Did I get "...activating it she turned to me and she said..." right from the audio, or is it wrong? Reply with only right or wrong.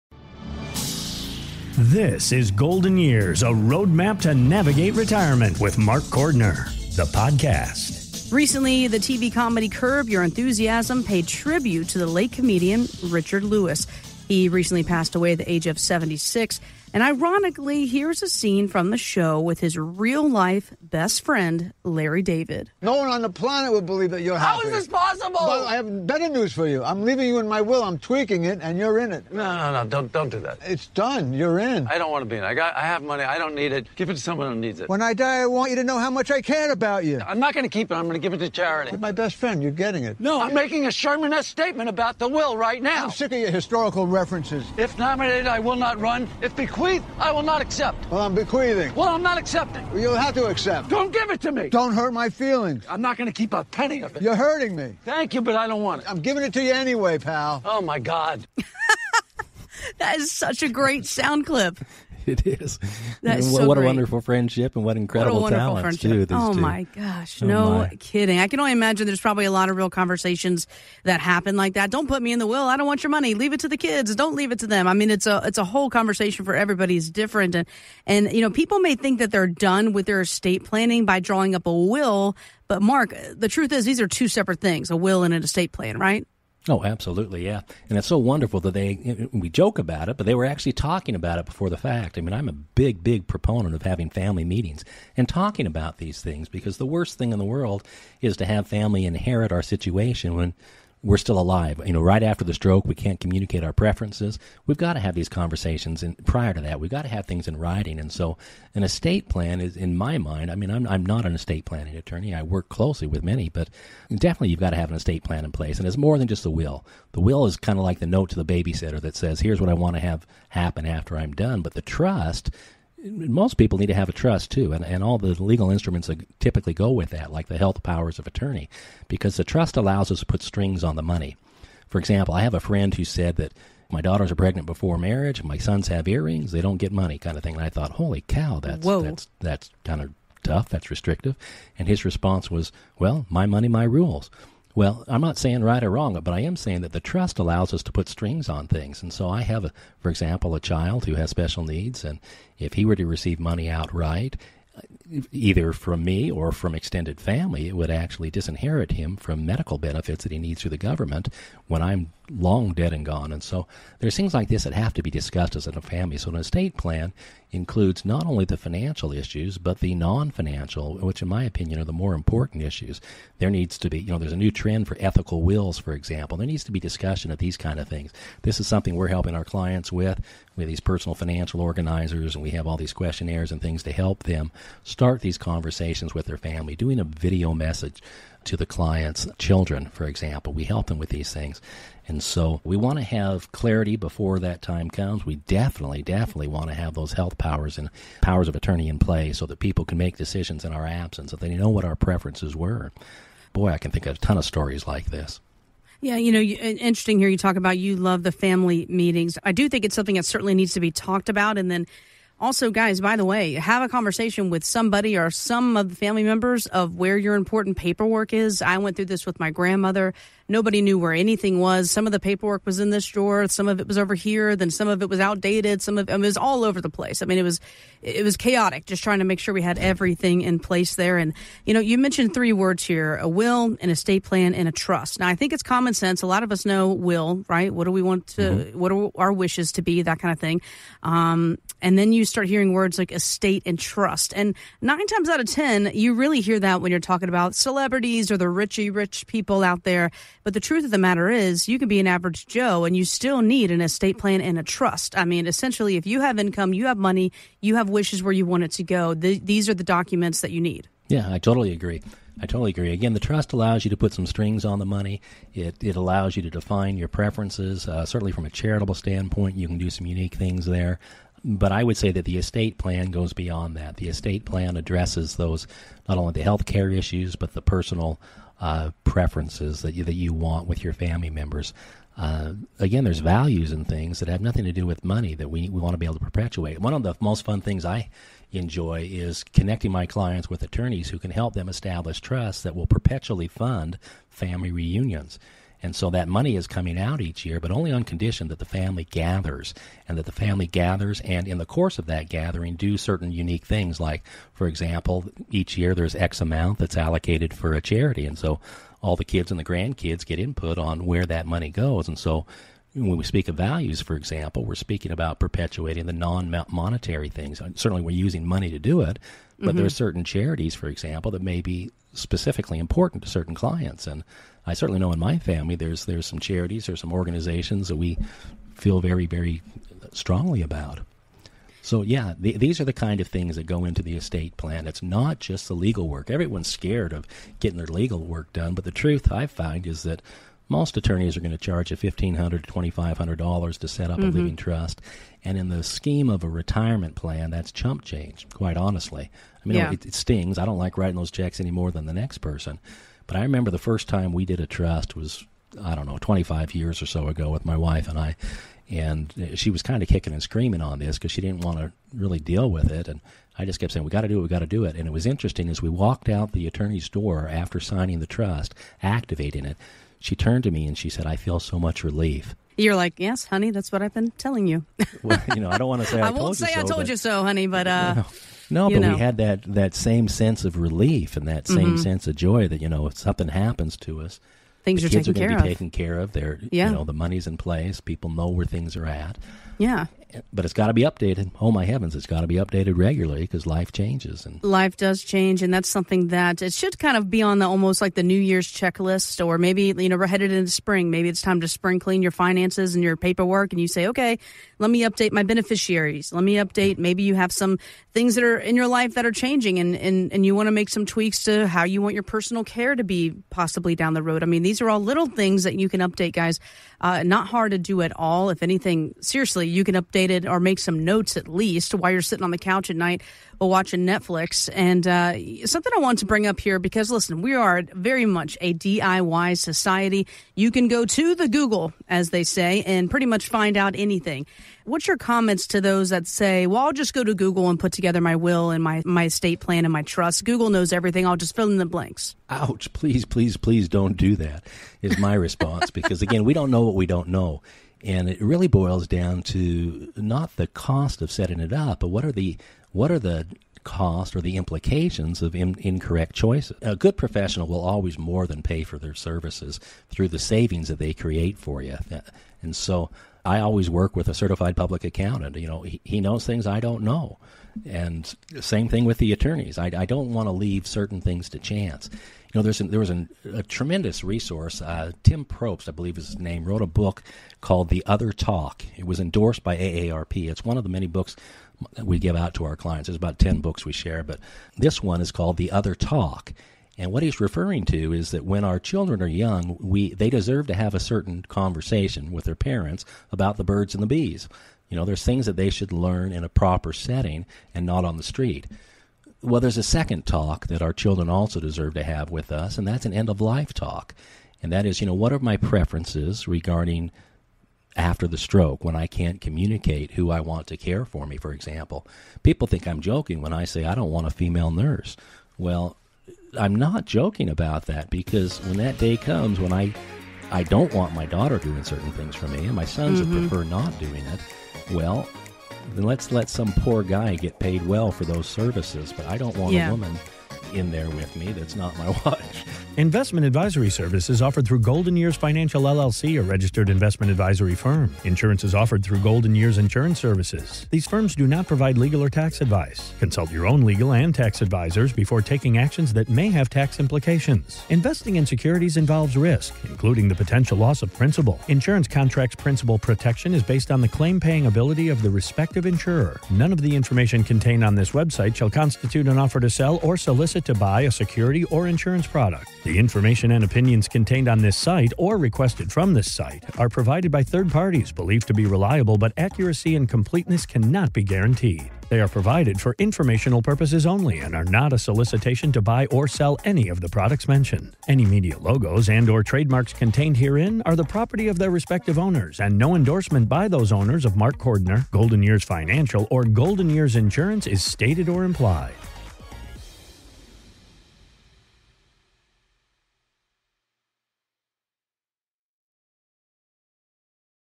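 right.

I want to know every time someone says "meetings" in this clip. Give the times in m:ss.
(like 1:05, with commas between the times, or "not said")
1:34, 3:28.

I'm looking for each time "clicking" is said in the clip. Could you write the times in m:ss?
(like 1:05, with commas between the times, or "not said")
not said.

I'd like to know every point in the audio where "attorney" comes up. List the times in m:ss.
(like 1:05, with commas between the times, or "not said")
1:51, 2:08, 3:18, 4:50, 5:40, 6:06, 7:49.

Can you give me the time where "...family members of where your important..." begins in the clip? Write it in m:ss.
3:35.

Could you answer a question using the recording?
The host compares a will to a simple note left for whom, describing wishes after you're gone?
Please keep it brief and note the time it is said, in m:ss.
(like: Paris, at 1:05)
the babysitter, at 1:58.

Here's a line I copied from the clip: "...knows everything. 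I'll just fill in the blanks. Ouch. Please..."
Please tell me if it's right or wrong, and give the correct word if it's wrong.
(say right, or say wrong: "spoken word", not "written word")
right.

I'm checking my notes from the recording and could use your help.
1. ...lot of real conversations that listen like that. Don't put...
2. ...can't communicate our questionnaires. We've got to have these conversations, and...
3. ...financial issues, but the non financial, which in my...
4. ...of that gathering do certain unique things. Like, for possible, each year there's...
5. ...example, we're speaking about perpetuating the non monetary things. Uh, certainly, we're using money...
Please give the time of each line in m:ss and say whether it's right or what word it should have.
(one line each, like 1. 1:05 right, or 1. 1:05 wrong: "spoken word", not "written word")
1. 1:09 wrong: "happen", not "listen"
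2. 1:42 wrong: "preferences", not "questionnaires"
3. 2:48 right
4. 5:01 wrong: "example", not "possible"
5. 5:14 right.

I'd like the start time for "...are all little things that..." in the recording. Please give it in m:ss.
6:54.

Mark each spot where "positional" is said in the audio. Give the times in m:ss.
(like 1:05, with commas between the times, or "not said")
not said.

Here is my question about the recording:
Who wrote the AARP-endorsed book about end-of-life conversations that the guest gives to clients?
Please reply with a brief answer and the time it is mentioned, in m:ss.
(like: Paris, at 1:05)
Tim Prosch, at 7:55.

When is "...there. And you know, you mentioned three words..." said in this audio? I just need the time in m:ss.
3:50.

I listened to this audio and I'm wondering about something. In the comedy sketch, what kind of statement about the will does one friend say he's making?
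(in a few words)
Sherman-esque.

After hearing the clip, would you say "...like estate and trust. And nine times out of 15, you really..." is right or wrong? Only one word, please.
wrong.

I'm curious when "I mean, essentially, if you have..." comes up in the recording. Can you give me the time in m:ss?
4:15.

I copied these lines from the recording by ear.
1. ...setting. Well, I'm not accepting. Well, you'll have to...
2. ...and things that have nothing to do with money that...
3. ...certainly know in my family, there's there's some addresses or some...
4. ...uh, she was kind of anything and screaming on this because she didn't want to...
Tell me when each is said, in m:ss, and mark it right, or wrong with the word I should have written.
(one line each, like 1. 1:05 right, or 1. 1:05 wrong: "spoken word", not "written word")
1. 0:48 wrong: "bequeathing", not "setting"
2. 4:43 right
3. 5:24 wrong: "charities", not "addresses"
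4. 5:59 wrong: "kicking", not "anything".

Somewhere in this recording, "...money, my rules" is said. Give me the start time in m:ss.
2:23.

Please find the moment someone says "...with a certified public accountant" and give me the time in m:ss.
7:44.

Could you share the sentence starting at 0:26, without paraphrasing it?
I'm leaving you in my will.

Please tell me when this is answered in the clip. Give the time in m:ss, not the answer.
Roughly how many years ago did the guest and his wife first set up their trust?
5:56.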